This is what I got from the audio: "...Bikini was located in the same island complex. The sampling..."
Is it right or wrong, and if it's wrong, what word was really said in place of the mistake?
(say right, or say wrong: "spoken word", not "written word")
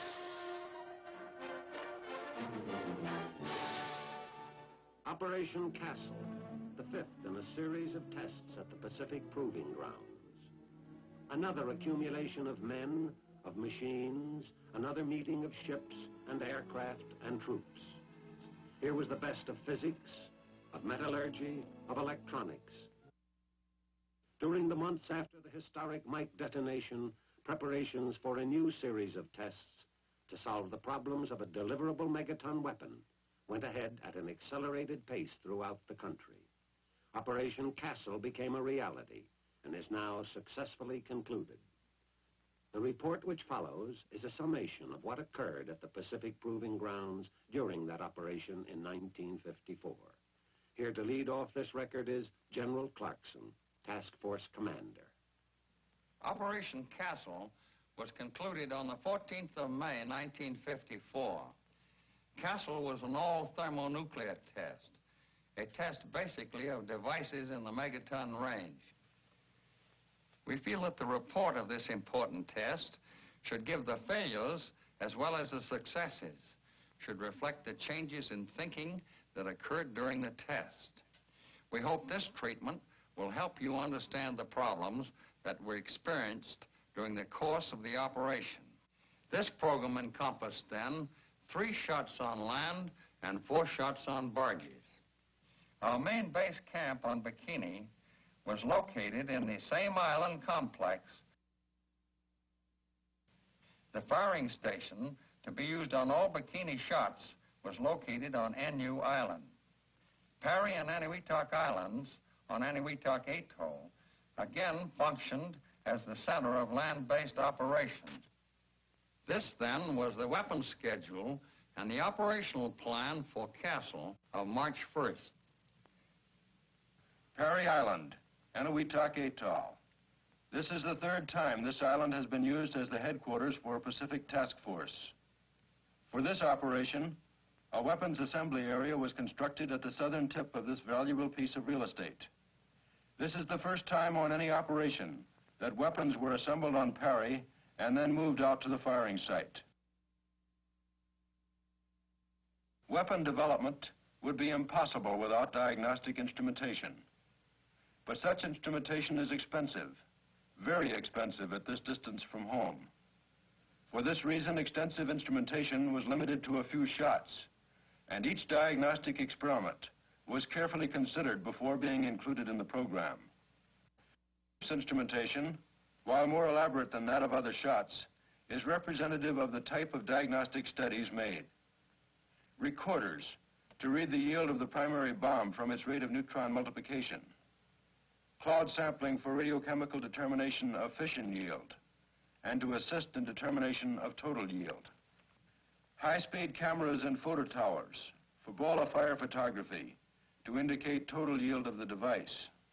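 wrong: "firing", not "sampling".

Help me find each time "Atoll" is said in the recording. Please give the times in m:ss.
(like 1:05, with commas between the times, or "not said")
1:53, 2:09.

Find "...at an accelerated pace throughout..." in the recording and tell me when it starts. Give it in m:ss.
0:34.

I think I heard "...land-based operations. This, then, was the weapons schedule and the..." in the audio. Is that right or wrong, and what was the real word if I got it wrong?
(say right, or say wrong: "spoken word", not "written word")
right.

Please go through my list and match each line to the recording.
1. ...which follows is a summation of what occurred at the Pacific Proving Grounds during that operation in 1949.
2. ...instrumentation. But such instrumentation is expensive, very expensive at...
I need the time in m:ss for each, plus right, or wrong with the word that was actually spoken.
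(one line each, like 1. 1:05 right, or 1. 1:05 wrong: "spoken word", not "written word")
1. 0:43 wrong: "1954", not "1949"
2. 2:36 right.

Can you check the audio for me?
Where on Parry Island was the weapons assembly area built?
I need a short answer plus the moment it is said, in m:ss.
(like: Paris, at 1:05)
Southern tip, at 2:19.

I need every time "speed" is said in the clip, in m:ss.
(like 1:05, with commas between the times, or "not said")
3:15.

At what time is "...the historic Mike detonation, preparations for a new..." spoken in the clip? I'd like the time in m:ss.
0:25.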